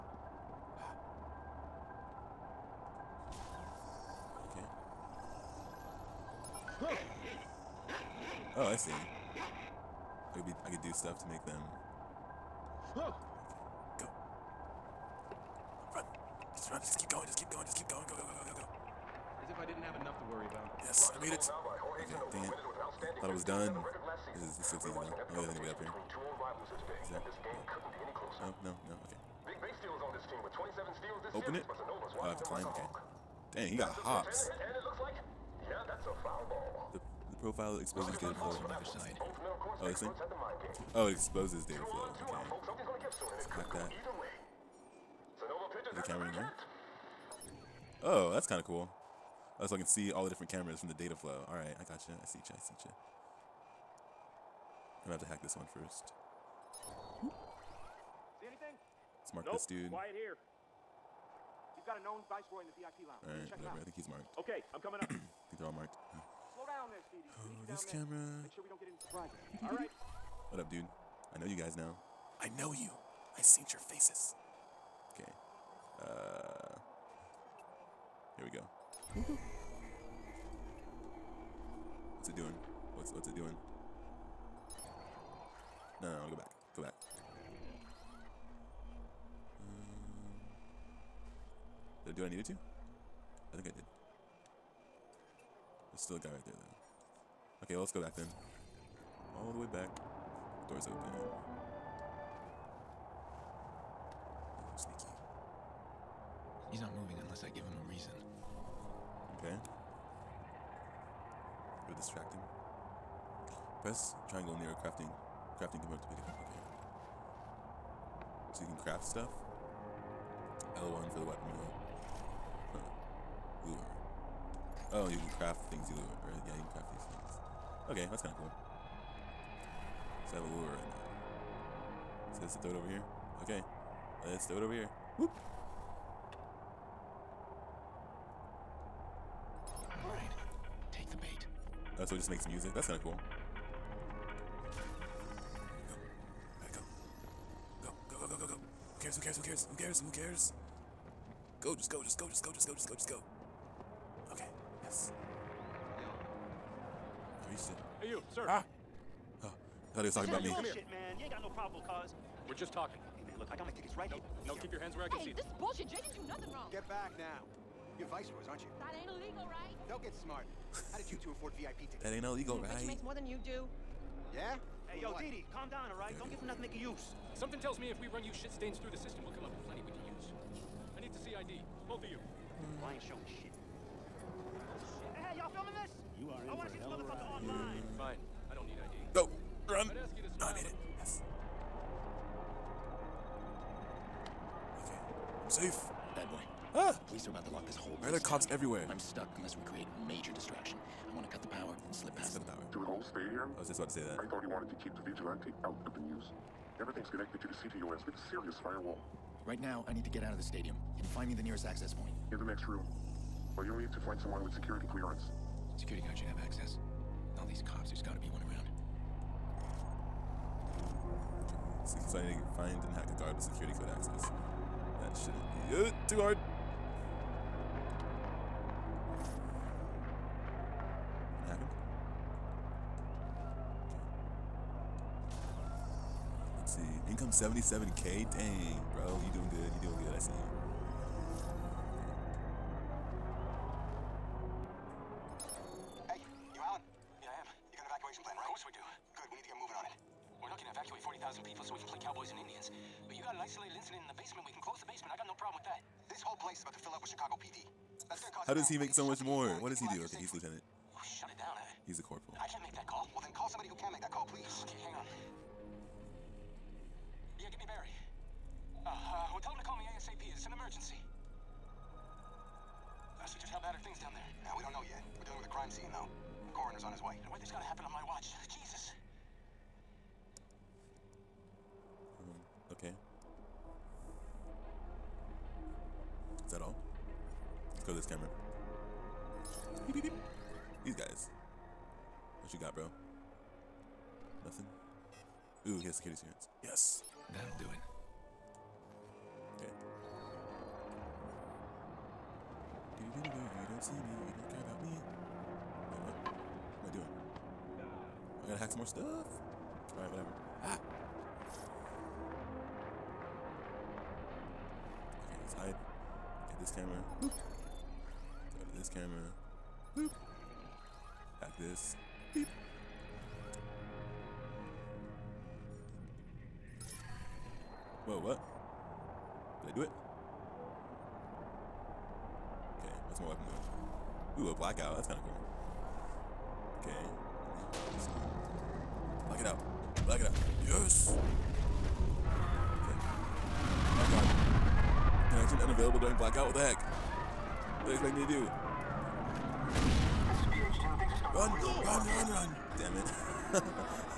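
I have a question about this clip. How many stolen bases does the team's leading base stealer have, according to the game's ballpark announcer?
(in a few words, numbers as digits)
27.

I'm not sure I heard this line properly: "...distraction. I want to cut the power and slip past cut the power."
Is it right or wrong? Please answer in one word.
right.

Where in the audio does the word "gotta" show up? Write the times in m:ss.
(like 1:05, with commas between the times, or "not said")
3:38, 4:37, 5:08.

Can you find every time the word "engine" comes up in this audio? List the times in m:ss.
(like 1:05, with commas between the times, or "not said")
not said.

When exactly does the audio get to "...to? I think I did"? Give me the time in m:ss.
1:32.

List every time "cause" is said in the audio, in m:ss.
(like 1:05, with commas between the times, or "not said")
2:41, 4:18.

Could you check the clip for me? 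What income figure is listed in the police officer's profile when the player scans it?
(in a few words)
77k.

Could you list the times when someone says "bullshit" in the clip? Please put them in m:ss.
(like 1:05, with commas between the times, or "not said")
2:45.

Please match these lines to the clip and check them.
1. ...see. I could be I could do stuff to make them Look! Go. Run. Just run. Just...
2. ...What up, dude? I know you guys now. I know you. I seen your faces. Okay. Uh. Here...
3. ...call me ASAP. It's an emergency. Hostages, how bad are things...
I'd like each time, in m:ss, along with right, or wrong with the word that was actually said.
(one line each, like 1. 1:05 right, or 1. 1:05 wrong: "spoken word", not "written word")
1. 0:08 right
2. 1:10 right
3. 4:29 right.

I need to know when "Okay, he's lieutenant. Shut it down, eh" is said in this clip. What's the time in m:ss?
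4:20.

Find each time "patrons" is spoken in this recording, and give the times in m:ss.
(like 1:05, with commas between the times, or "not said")
not said.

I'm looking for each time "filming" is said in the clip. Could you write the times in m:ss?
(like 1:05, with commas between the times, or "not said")
3:05.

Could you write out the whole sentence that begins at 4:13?
But you got an isolated incident in the basement, we can close the basement.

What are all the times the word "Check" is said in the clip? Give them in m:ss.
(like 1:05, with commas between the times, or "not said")
1:03.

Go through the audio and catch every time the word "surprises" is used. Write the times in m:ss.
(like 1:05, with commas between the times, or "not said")
1:08.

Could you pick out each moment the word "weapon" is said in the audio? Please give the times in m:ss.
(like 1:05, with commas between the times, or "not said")
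2:01, 5:33.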